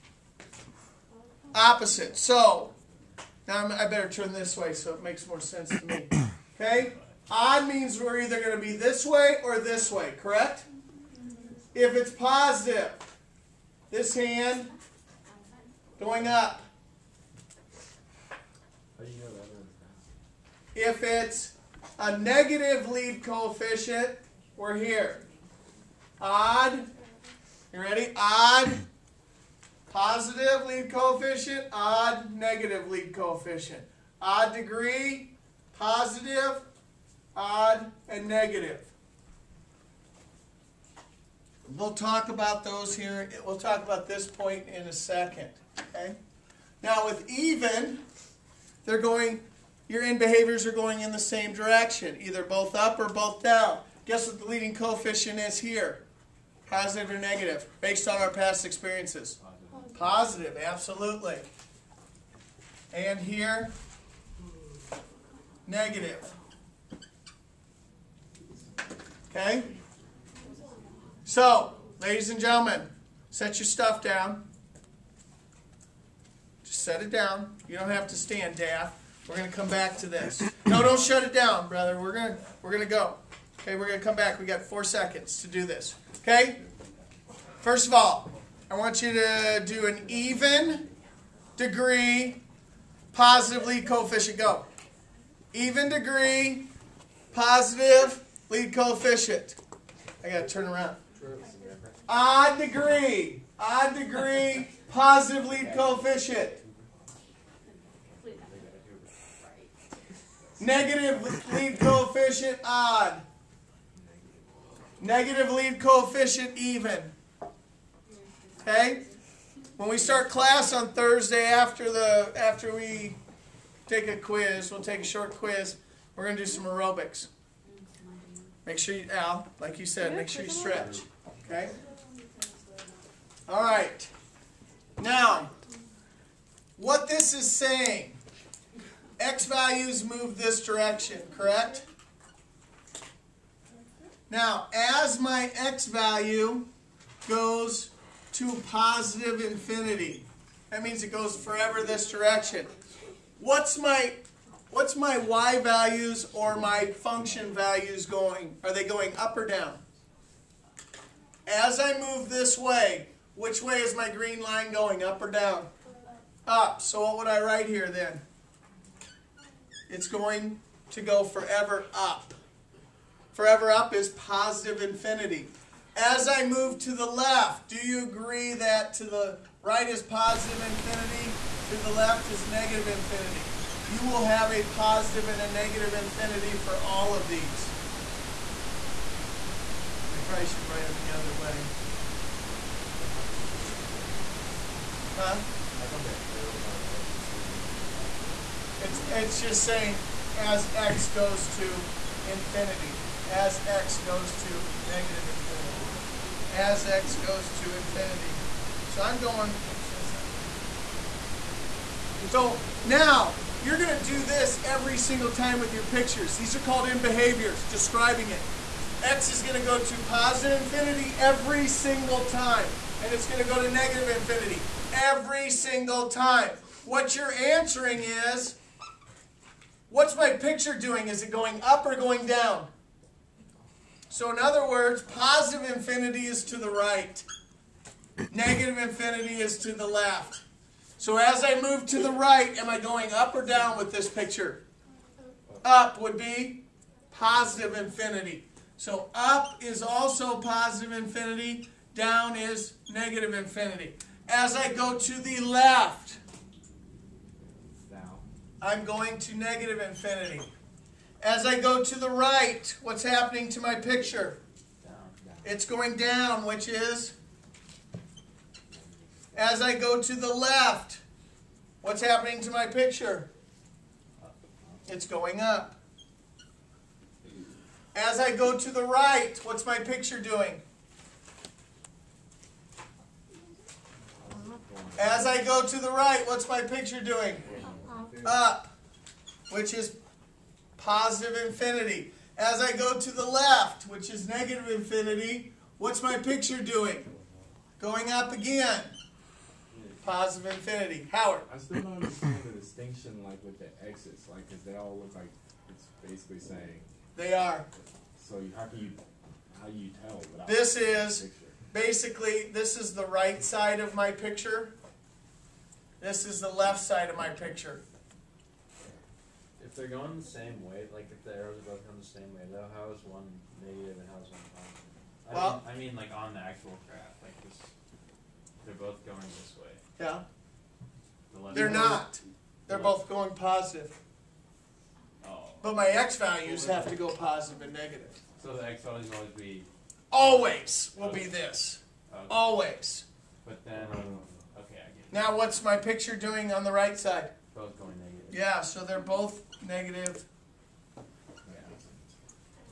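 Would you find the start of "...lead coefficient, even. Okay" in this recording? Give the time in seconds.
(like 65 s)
115 s.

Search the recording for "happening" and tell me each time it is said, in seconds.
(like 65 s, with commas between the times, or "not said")
263 s, 272 s.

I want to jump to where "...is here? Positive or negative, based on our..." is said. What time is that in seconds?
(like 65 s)
55 s.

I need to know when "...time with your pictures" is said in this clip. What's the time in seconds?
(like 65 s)
215 s.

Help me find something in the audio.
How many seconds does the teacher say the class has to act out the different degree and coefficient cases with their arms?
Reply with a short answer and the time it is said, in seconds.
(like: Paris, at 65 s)
4, at 84 s.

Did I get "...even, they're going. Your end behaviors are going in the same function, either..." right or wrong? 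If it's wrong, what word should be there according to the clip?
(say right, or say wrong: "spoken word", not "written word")
wrong: "direction", not "function".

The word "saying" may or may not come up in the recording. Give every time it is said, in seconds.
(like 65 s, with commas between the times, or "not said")
137 s, 199 s, 306 s.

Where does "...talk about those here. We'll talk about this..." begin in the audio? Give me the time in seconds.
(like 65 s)
41 s.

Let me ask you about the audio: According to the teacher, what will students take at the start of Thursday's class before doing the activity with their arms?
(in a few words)
a short quiz.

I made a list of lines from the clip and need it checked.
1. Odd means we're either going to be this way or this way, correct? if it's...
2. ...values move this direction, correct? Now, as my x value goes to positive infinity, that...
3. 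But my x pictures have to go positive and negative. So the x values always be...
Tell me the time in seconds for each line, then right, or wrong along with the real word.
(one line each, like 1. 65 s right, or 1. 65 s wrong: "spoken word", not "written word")
1. 7 s right
2. 139 s right
3. 335 s wrong: "values", not "pictures".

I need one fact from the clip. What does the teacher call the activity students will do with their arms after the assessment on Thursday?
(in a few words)
aerobics.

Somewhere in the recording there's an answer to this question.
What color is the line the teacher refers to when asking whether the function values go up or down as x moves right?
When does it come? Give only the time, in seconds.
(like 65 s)
164 s.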